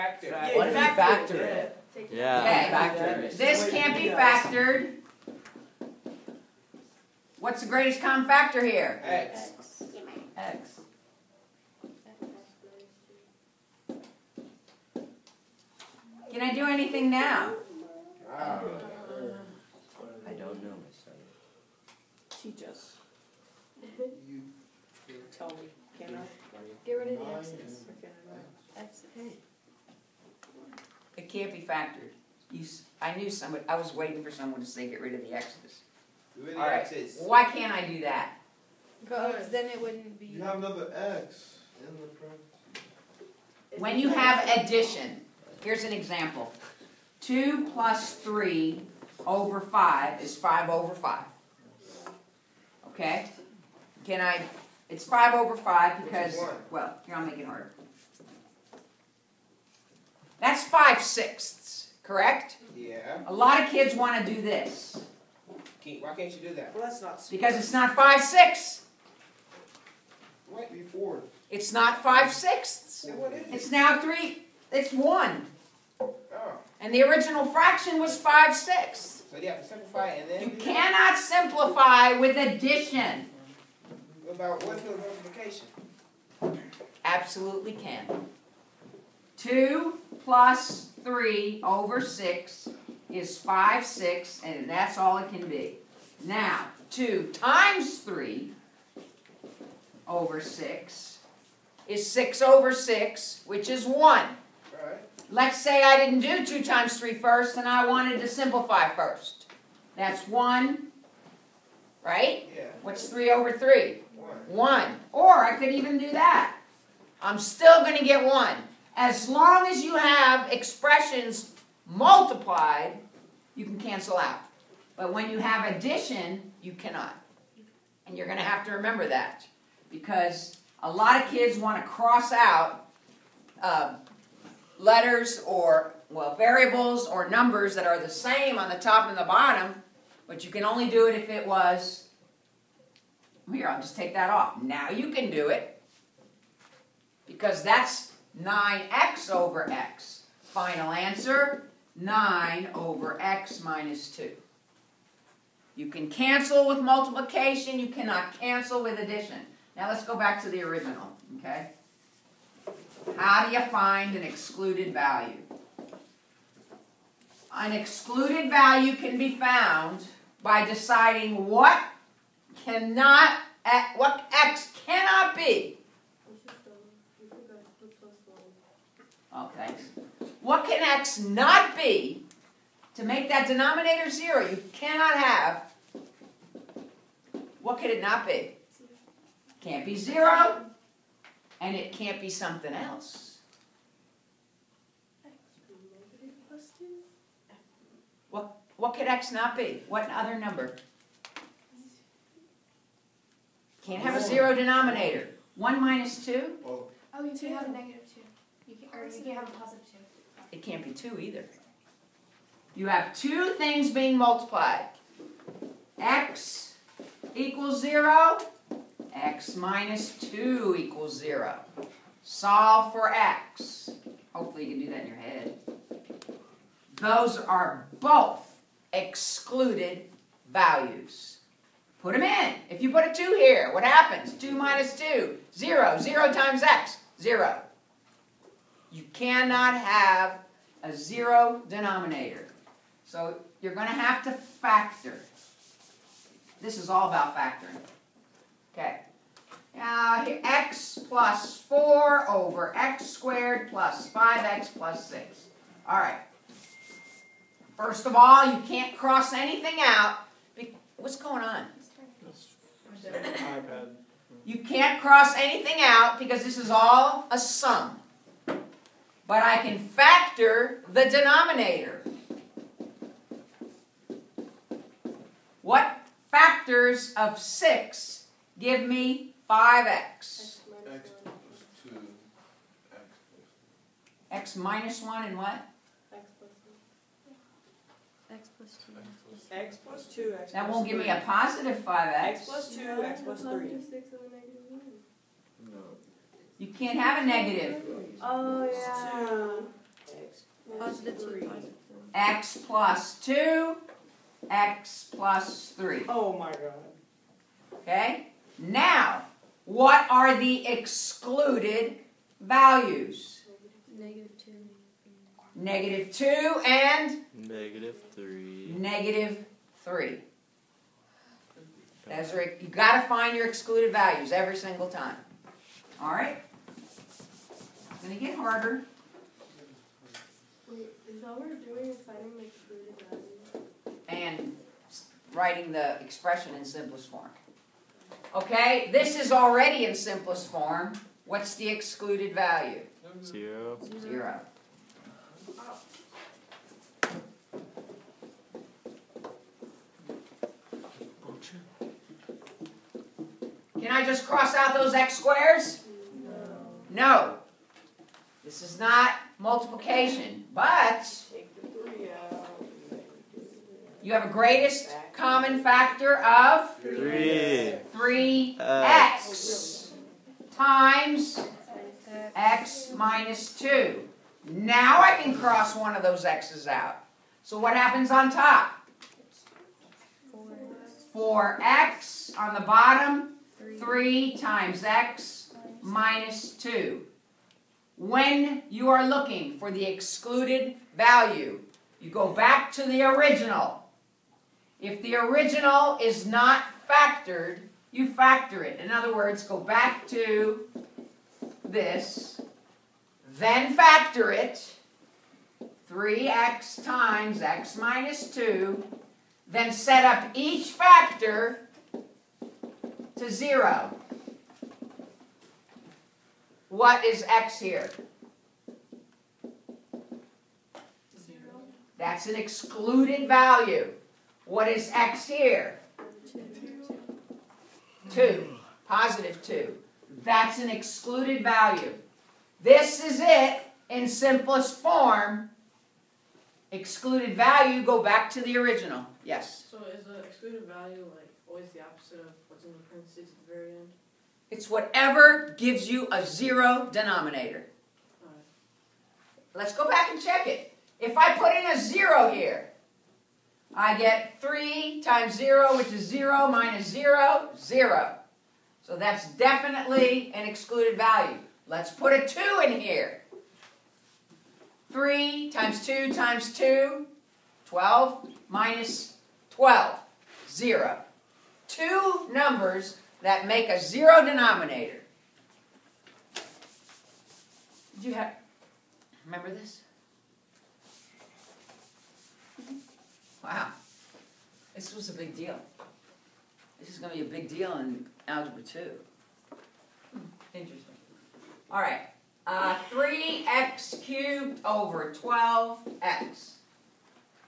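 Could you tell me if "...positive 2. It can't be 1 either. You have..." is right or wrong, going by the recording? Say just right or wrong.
wrong.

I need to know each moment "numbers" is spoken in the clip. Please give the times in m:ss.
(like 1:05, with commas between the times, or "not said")
2:17, 3:20, 7:52.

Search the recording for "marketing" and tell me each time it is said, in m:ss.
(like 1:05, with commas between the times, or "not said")
not said.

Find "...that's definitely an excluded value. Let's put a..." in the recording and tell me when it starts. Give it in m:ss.
7:38.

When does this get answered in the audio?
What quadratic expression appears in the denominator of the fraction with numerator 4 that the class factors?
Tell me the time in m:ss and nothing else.
4:12.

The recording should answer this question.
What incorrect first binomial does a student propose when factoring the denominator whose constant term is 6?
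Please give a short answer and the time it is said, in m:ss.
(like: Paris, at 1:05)
x minus 1, at 4:44.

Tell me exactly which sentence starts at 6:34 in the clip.
If the original is not factored, you factor it.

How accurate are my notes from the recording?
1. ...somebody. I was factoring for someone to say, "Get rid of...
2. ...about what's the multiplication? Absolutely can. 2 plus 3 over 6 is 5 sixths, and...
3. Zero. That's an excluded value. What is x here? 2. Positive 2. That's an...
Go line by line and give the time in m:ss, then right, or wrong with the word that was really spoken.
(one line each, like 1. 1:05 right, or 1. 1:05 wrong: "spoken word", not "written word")
1. 0:33 wrong: "waiting", not "factoring"
2. 1:24 right
3. 7:01 right.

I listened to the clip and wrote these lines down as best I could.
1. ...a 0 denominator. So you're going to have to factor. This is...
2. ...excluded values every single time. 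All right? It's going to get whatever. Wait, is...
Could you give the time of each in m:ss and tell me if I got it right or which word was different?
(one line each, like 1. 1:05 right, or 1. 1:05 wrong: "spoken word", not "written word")
1. 4:00 right
2. 5:23 wrong: "harder", not "whatever".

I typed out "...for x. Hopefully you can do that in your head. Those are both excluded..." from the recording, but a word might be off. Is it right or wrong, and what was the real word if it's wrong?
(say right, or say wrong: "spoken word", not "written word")
right.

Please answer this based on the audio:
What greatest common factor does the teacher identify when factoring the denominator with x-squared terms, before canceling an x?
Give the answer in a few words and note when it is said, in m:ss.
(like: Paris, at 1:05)
3, at 6:06.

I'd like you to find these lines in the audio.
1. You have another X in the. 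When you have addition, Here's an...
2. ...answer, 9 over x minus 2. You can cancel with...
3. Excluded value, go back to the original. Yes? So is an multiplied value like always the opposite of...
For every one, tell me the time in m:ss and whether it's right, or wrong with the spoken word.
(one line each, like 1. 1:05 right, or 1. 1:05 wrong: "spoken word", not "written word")
1. 0:40 right
2. 2:30 right
3. 7:16 wrong: "excluded", not "multiplied".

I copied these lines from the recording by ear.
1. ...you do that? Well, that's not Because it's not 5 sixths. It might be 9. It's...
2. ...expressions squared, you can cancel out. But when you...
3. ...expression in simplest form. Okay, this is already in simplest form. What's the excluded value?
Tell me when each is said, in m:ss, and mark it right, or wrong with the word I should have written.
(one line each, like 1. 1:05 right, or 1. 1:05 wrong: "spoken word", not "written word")
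1. 1:06 wrong: "4", not "9"
2. 2:00 wrong: "multiplied", not "squared"
3. 5:36 right.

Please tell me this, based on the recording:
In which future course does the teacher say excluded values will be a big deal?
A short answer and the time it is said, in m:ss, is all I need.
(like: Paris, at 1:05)
Algebra 2, at 8:08.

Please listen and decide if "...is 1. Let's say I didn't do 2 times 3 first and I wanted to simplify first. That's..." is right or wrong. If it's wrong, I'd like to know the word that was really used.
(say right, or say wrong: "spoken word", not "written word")
right.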